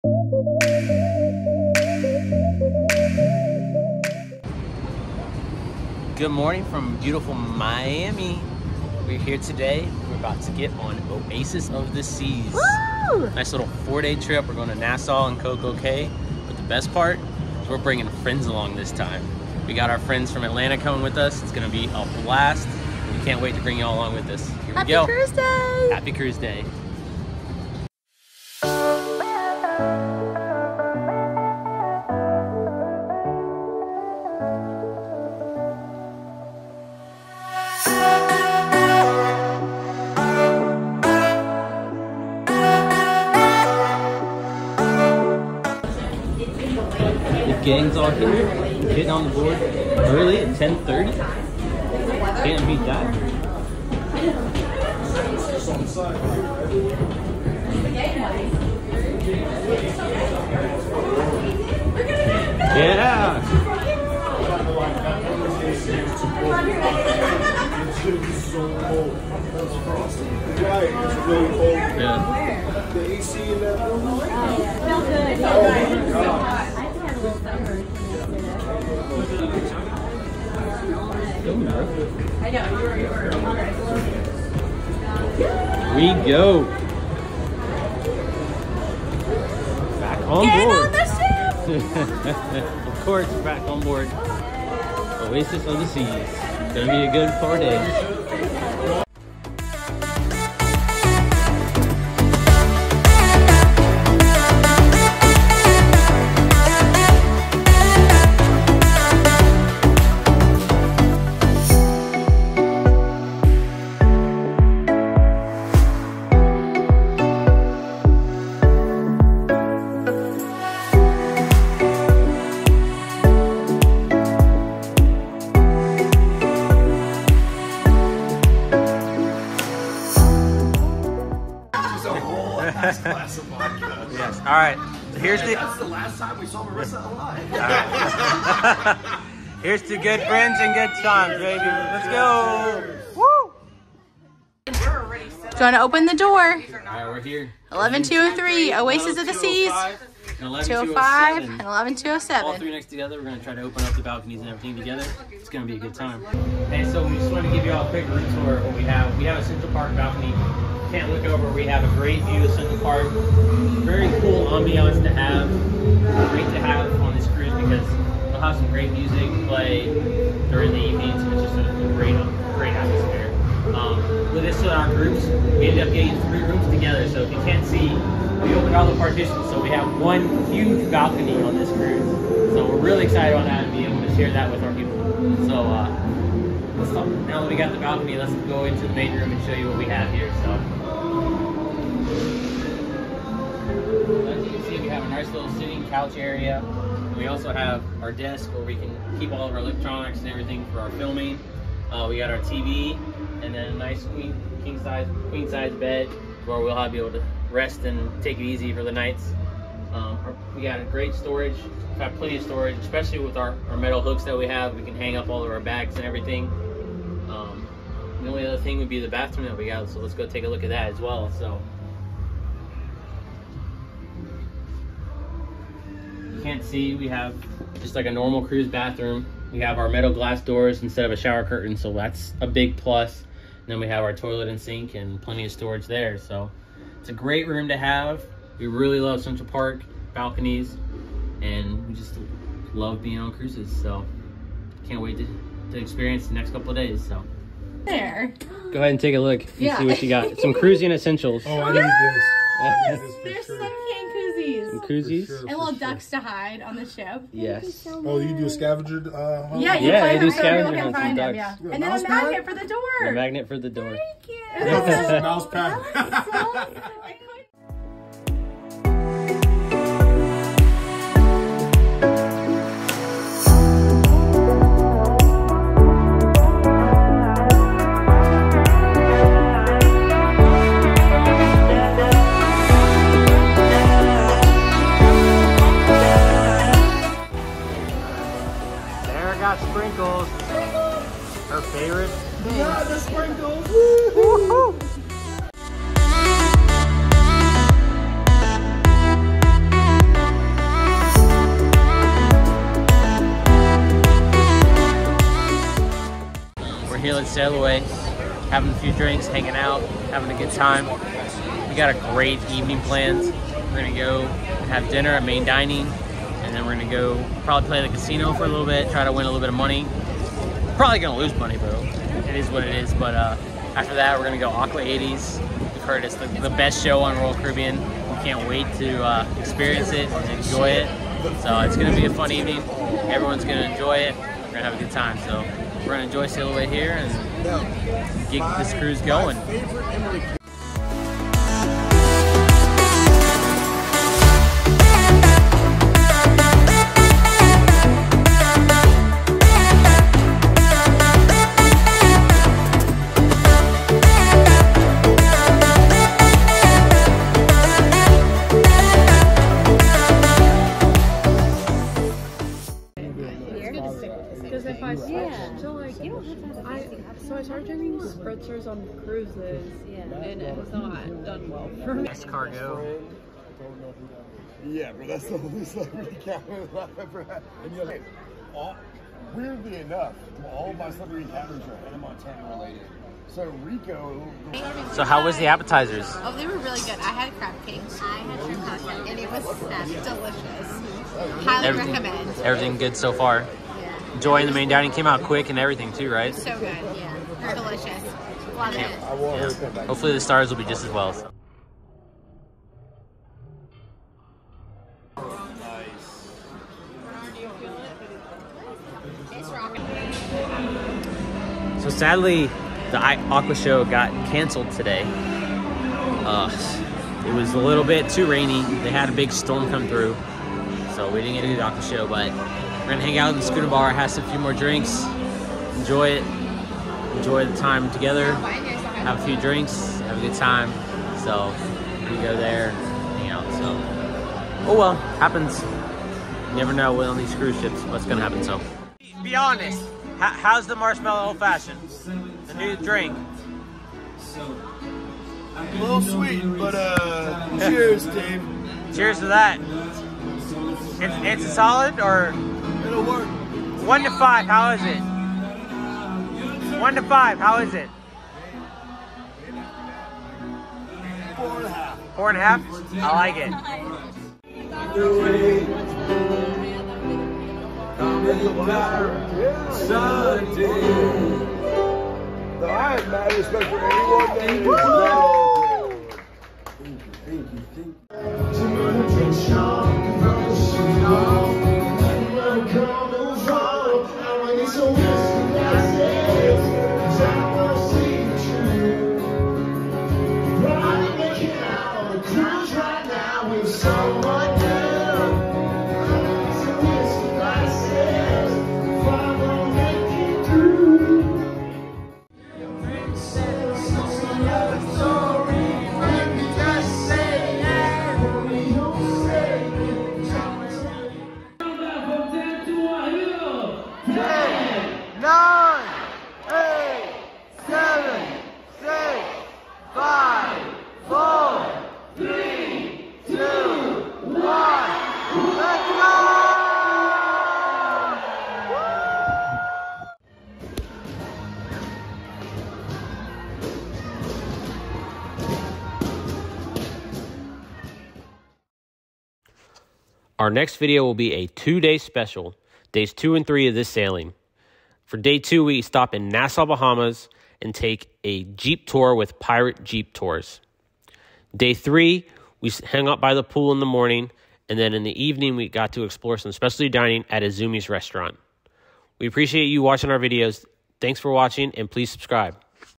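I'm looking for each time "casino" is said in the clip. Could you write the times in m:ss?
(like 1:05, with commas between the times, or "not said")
5:17.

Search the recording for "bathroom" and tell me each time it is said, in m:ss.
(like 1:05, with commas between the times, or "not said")
3:39, 3:48.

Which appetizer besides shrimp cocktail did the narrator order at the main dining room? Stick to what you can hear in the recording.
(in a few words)
Crab cake.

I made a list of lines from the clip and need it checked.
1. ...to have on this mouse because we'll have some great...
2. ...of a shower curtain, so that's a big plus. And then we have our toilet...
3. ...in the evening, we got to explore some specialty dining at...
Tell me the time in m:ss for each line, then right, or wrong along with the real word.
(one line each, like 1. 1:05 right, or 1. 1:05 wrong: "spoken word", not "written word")
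1. 2:46 wrong: "cruise", not "mouse"
2. 3:51 right
3. 9:14 right.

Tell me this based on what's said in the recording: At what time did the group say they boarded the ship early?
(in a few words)
10:30.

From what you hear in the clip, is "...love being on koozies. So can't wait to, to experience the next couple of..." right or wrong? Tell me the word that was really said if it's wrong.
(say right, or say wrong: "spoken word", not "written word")
wrong: "cruises", not "koozies".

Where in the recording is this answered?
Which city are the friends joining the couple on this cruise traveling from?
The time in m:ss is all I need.
0:20.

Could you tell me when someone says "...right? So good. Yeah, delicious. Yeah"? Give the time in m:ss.
6:36.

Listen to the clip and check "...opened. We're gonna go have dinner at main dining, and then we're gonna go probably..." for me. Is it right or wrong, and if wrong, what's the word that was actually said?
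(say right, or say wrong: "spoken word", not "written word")
wrong: "planned", not "opened".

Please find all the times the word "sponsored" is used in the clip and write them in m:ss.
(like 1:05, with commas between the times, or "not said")
not said.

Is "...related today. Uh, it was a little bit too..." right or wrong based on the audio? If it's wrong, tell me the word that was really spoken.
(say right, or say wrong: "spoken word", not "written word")
wrong: "canceled", not "related".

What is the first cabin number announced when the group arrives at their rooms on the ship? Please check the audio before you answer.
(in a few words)
11203.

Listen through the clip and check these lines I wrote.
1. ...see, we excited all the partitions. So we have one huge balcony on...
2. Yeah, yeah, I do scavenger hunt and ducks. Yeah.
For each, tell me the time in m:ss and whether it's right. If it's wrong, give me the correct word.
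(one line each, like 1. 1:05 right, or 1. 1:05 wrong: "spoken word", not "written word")
1. 2:57 wrong: "opened", not "excited"
2. 4:19 right.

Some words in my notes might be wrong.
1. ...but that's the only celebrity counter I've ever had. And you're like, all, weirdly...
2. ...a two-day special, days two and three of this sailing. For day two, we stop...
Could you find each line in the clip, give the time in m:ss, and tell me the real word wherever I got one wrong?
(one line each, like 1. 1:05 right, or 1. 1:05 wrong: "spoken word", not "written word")
1. 6:14 right
2. 9:01 right.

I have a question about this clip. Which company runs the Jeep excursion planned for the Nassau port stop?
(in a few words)
Pirate Jeep Tours.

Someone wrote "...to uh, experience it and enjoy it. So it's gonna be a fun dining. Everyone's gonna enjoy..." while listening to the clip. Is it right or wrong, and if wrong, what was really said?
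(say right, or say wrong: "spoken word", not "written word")
wrong: "evening", not "dining".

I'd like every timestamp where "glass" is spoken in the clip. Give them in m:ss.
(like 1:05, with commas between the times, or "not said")
3:50.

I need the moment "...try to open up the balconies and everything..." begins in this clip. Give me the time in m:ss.
2:33.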